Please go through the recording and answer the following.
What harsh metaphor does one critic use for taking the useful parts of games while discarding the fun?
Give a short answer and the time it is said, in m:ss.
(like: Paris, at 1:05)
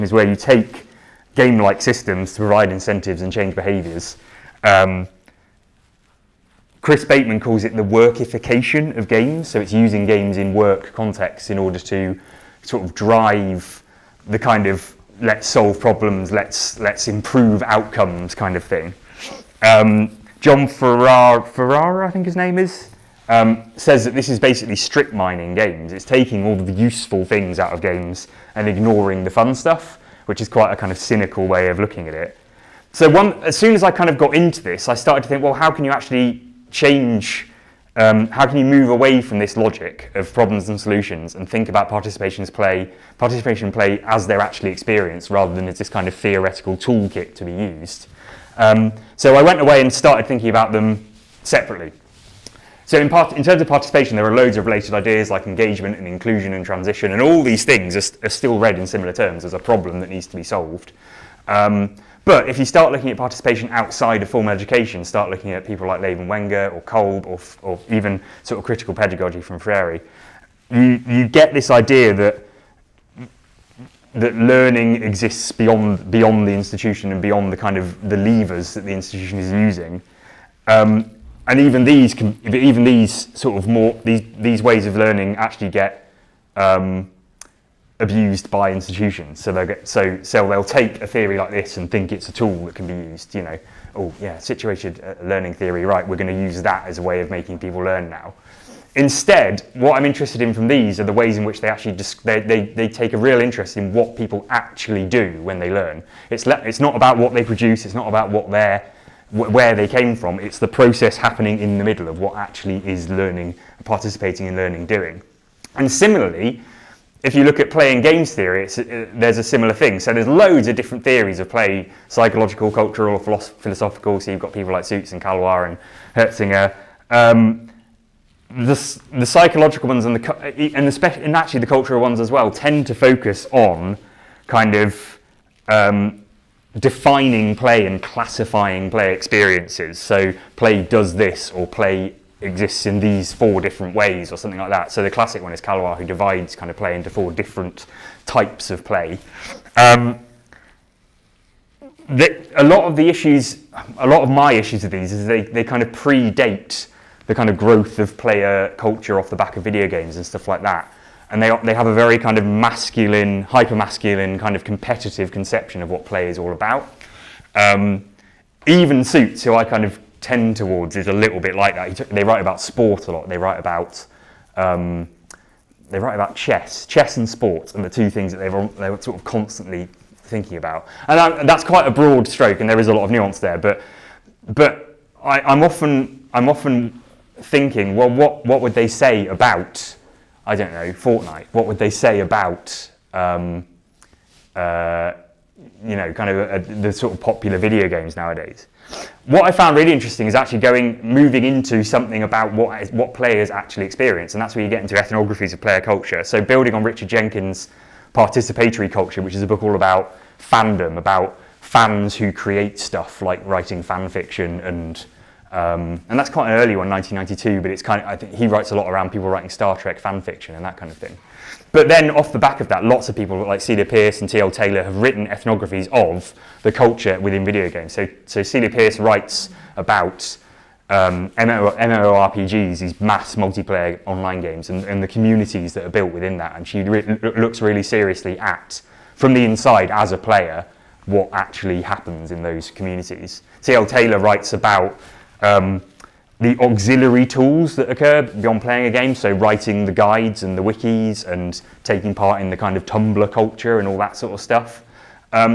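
strip mining games, at 0:24.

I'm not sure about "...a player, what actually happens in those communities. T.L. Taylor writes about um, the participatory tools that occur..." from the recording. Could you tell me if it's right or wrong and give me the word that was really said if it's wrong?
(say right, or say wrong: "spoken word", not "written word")
wrong: "auxiliary", not "participatory".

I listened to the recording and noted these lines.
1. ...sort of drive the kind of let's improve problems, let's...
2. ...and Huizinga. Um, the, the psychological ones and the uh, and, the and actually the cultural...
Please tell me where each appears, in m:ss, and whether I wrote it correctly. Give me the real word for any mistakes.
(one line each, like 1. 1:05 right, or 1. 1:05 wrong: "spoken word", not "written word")
1. 0:12 wrong: "solve", not "improve"
2. 2:05 right.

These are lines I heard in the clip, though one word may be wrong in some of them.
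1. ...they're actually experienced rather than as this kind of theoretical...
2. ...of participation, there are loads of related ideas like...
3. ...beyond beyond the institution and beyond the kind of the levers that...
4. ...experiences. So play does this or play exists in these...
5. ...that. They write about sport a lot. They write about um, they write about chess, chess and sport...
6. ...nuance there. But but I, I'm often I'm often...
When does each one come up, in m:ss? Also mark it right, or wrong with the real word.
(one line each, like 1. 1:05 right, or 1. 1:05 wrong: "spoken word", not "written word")
1. 0:44 right
2. 0:53 right
3. 1:15 right
4. 2:19 right
5. 2:51 right
6. 3:03 right.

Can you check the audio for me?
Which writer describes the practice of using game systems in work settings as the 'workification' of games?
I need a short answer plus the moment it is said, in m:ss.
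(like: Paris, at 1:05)
Chris Bateman, at 0:06.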